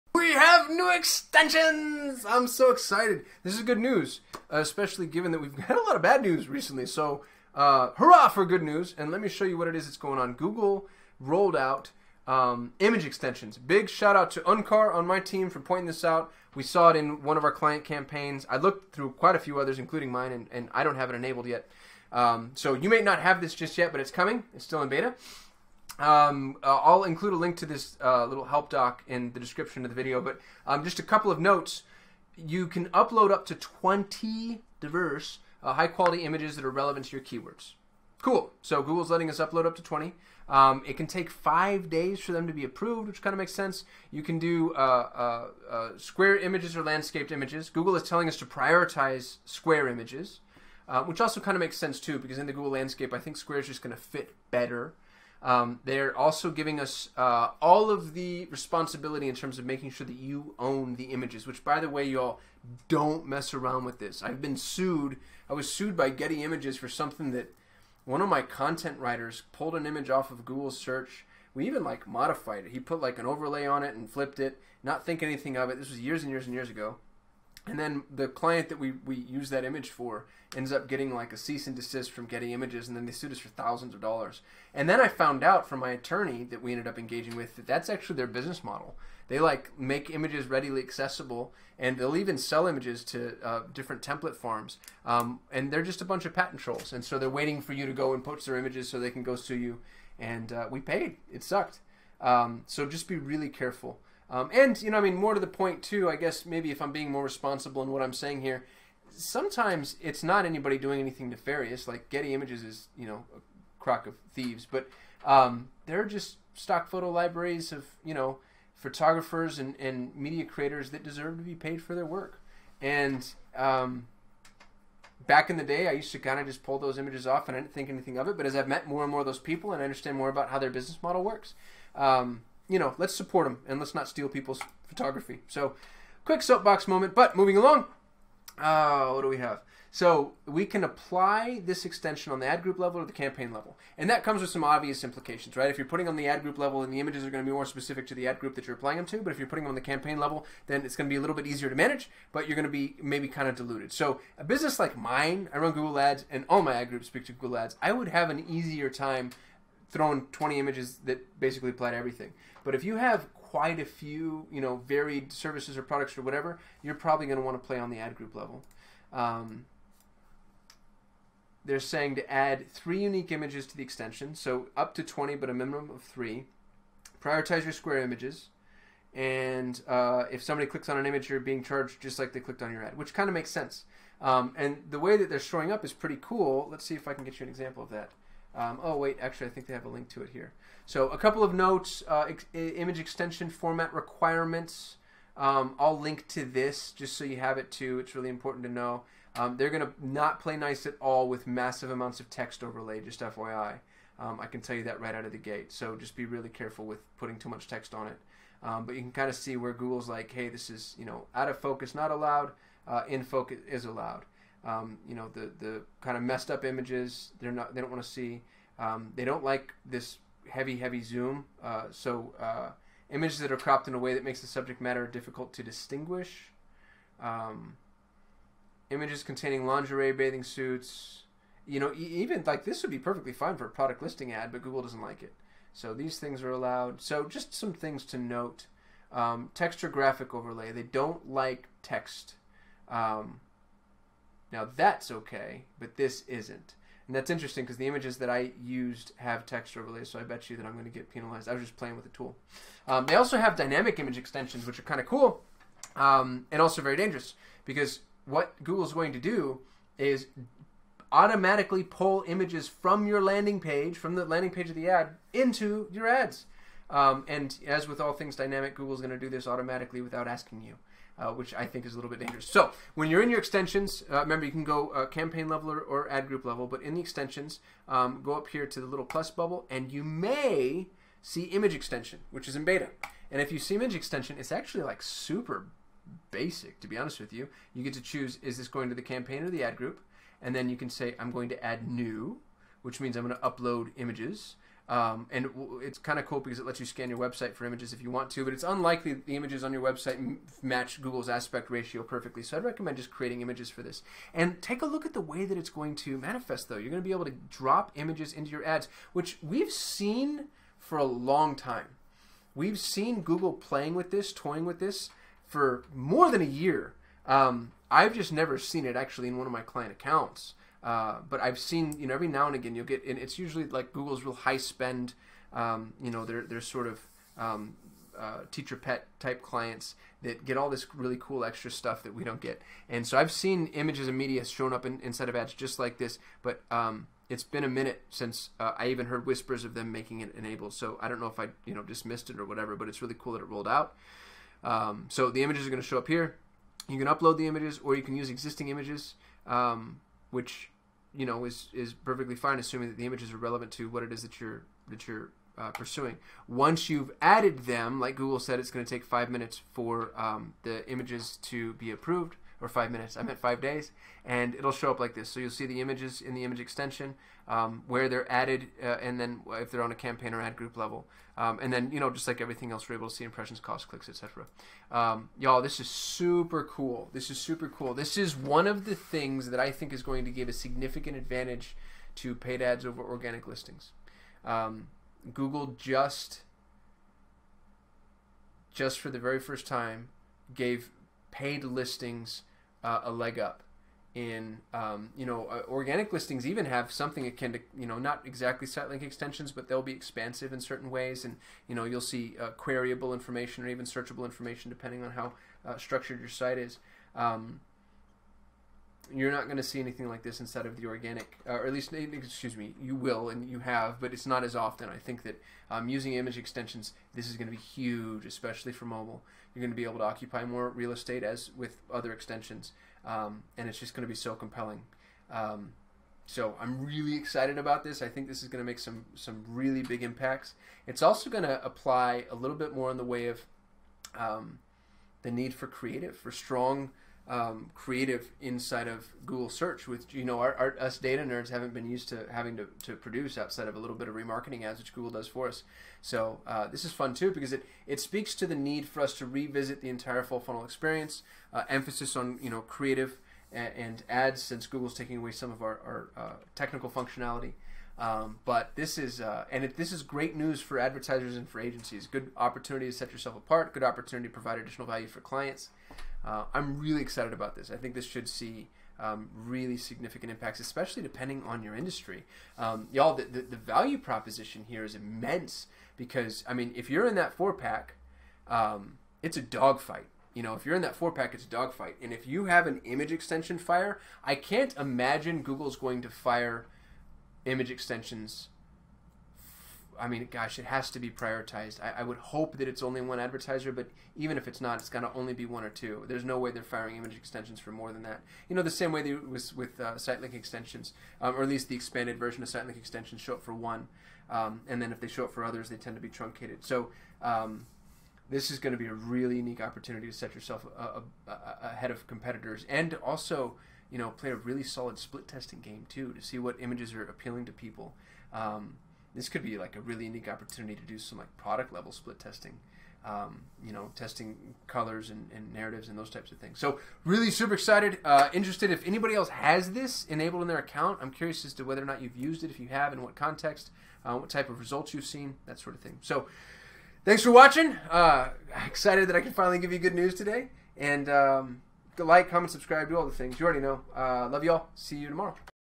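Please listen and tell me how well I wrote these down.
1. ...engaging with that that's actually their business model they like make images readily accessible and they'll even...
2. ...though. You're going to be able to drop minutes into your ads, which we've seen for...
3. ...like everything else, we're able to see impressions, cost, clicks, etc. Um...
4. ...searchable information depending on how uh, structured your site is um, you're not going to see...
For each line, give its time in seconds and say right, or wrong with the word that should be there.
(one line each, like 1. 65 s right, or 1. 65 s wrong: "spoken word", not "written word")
1. 86 s right
2. 306 s wrong: "images", not "minutes"
3. 372 s right
4. 403 s right.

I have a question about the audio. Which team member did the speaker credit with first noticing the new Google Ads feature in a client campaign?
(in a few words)
Uncar.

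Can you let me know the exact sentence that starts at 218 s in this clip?
Um, they don't like this heavy heavy zoom.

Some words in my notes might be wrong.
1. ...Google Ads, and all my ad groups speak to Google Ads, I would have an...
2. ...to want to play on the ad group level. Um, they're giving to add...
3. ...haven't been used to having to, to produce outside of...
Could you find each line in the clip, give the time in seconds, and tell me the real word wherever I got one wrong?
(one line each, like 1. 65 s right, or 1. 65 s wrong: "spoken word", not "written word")
1. 155 s right
2. 167 s wrong: "saying", not "giving"
3. 441 s right.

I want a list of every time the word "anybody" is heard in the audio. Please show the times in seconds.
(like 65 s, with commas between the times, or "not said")
110 s, 528 s.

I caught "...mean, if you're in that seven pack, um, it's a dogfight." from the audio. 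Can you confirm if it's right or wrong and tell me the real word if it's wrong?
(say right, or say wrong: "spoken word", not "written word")
wrong: "four", not "seven".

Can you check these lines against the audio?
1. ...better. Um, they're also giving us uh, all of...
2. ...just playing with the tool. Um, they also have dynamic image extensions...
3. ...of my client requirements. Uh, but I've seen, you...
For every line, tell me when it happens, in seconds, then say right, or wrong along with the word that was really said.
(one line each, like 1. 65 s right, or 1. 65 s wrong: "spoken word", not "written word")
1. 54 s right
2. 251 s right
3. 319 s wrong: "accounts", not "requirements".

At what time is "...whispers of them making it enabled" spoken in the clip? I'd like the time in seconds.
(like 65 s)
339 s.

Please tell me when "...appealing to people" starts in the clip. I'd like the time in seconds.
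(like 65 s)
517 s.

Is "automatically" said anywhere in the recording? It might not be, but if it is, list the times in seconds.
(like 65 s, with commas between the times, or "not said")
261 s, 269 s.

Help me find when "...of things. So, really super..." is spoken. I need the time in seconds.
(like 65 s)
526 s.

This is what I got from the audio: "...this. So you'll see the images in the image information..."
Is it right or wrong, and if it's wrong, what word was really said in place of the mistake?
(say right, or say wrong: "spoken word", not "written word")
wrong: "extension", not "information".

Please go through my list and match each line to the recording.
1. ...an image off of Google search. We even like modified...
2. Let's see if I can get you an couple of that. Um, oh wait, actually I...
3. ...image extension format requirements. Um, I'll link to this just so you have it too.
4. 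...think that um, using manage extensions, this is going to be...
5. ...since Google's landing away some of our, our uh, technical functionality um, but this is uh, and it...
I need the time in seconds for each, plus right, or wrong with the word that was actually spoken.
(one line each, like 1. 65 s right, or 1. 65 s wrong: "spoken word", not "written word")
1. 69 s right
2. 186 s wrong: "example", not "couple"
3. 192 s right
4. 414 s wrong: "image", not "manage"
5. 454 s wrong: "taking", not "landing".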